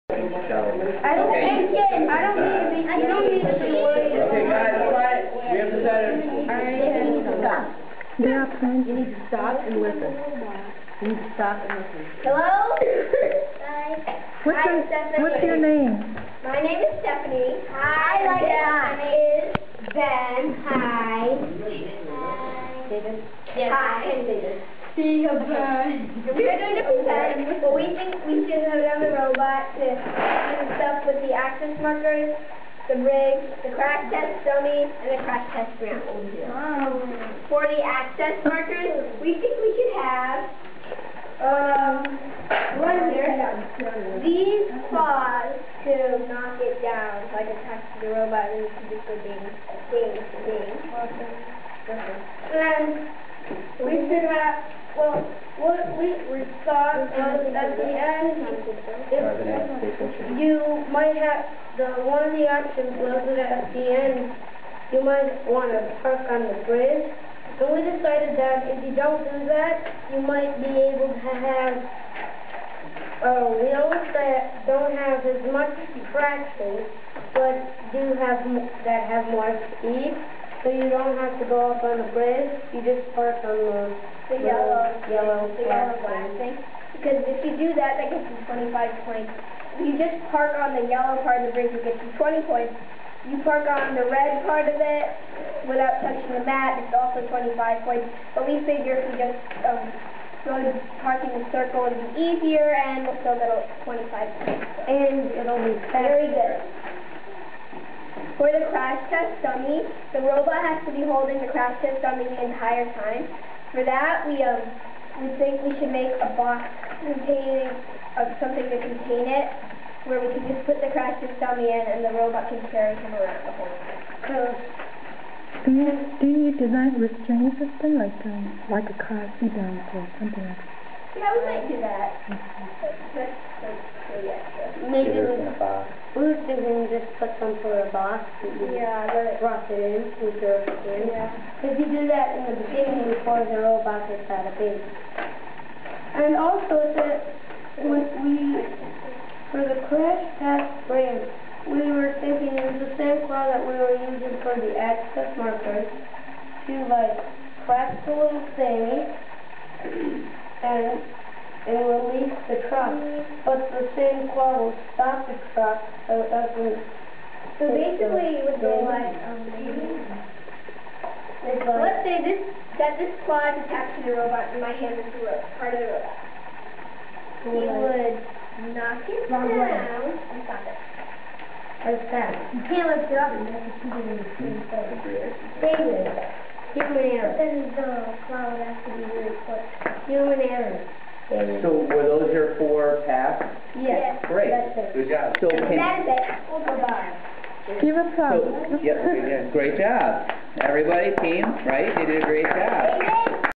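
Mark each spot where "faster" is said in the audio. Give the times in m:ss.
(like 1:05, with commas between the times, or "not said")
1:45.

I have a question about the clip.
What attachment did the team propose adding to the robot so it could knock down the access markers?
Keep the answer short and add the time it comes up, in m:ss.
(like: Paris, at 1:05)
Claws, at 0:44.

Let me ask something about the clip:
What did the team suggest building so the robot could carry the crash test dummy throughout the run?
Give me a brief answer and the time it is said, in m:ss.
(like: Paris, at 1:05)
A box, at 2:17.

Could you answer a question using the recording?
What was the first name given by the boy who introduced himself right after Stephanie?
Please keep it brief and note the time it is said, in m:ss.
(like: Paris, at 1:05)
Ben, at 0:19.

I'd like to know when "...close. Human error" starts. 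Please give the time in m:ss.
3:09.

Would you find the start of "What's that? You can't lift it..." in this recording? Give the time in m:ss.
3:01.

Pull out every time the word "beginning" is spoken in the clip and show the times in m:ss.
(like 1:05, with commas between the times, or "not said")
2:22.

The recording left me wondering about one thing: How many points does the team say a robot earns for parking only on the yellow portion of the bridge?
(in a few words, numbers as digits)
20.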